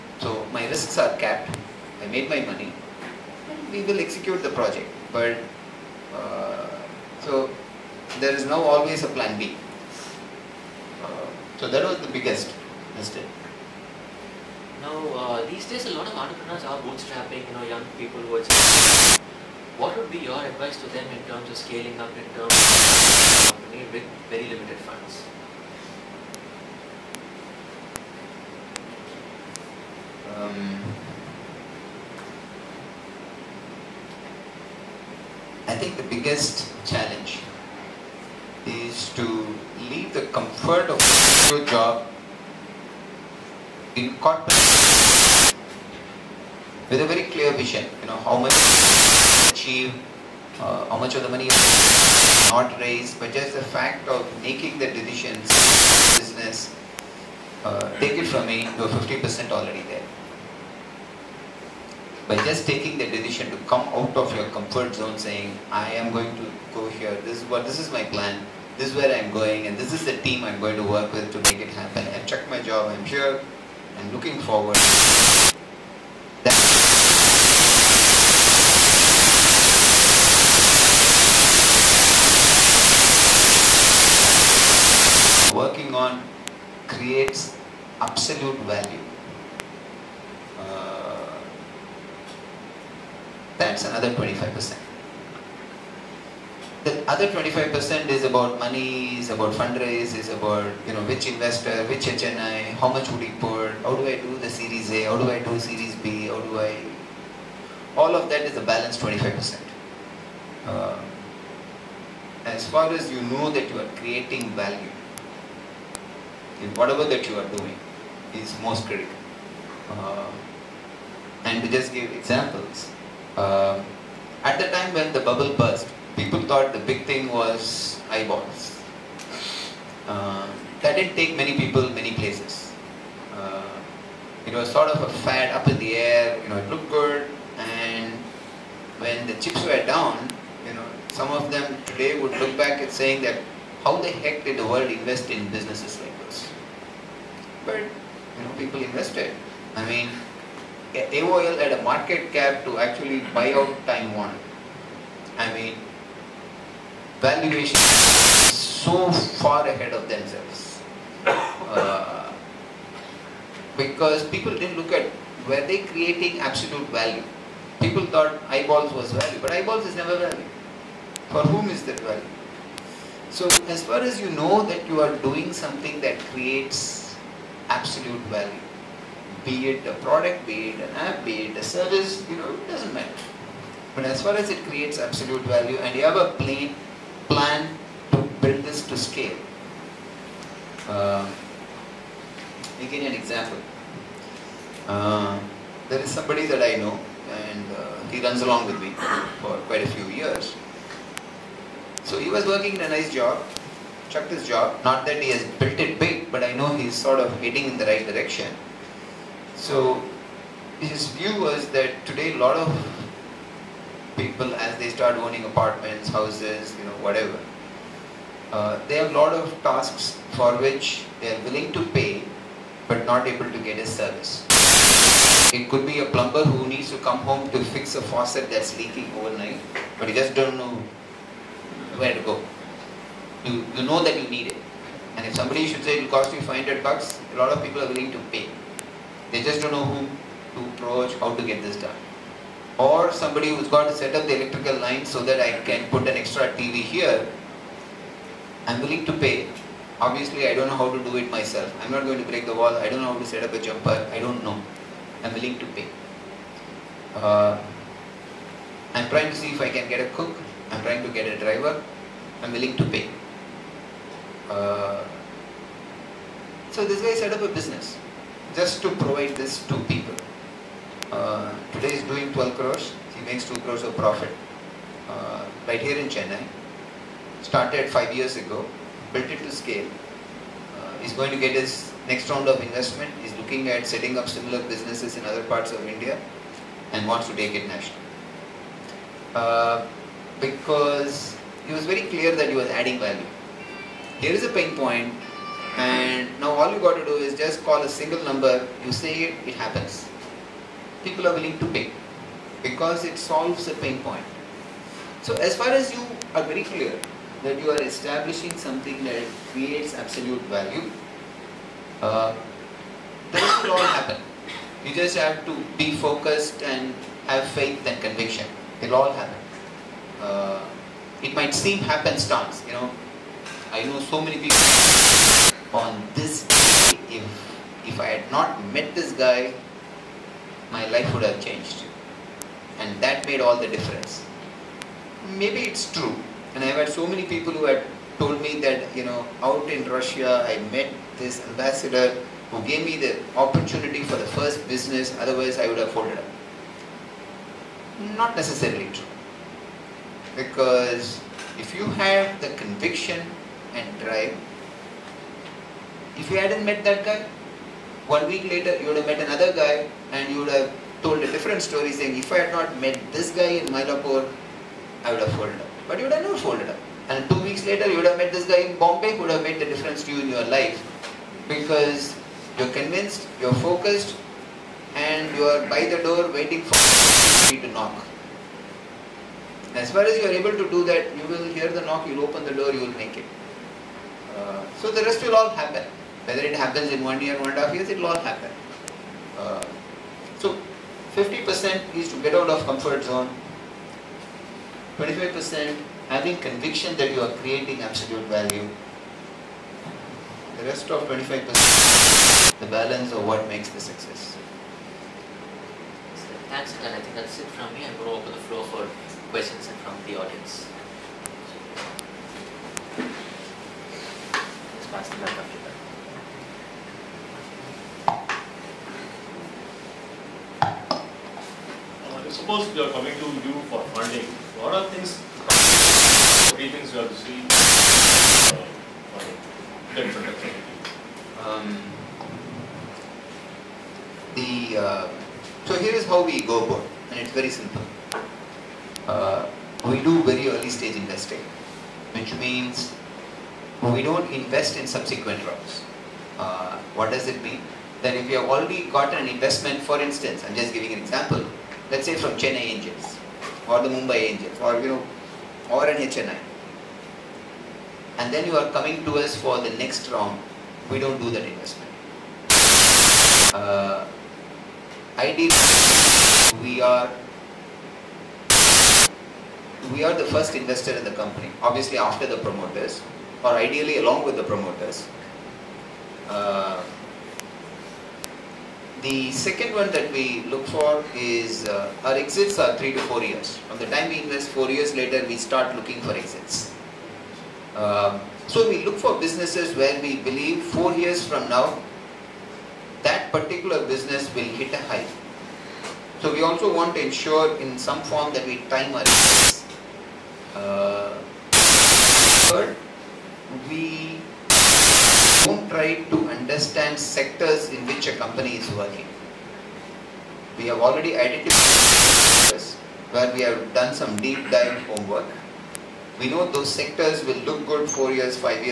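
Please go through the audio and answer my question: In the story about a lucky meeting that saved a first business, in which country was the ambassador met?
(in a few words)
Russia.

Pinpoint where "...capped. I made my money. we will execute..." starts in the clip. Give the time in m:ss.
0:01.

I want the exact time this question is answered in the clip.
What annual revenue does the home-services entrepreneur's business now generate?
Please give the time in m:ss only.
4:32.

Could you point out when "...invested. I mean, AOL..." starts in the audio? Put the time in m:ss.
2:28.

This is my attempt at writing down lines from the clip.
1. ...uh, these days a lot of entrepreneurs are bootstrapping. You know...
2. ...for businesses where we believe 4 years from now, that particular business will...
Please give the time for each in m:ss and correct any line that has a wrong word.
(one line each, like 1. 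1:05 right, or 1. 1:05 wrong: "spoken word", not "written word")
1. 0:15 right
2. 8:08 right.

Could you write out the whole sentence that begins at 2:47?
People thought eyeballs was value, but eyeballs is never value.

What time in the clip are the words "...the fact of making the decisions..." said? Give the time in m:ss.
0:53.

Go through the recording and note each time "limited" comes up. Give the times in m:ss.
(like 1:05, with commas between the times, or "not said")
0:24.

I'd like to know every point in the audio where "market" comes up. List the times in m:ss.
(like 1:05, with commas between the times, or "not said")
2:31.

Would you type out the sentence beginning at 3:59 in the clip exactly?
They just don't know who to approach, how to get this done.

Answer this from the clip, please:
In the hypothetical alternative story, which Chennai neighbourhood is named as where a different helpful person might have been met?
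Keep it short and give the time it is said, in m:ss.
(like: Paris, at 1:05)
Mylapore, at 6:03.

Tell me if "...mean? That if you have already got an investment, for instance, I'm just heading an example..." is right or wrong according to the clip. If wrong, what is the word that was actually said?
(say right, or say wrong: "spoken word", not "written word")
wrong: "giving", not "heading".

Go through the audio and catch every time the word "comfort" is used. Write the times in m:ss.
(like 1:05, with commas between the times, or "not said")
0:40, 1:04, 6:32.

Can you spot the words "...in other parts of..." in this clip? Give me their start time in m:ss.
4:45.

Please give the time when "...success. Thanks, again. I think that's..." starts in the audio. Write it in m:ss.
6:43.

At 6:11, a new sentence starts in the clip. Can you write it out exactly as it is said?
Because you're convinced, you're focused, and you're by the door waiting for somebody to knock.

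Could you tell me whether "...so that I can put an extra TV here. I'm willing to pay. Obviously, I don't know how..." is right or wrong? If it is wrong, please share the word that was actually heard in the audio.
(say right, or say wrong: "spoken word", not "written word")
right.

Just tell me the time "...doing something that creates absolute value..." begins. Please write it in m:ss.
2:55.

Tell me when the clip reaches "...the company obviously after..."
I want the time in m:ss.
7:51.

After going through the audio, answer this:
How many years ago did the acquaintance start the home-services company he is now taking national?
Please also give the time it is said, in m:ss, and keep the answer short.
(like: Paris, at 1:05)
5, at 4:37.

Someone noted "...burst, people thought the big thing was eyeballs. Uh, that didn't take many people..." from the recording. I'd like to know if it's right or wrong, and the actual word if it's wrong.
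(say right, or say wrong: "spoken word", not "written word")
right.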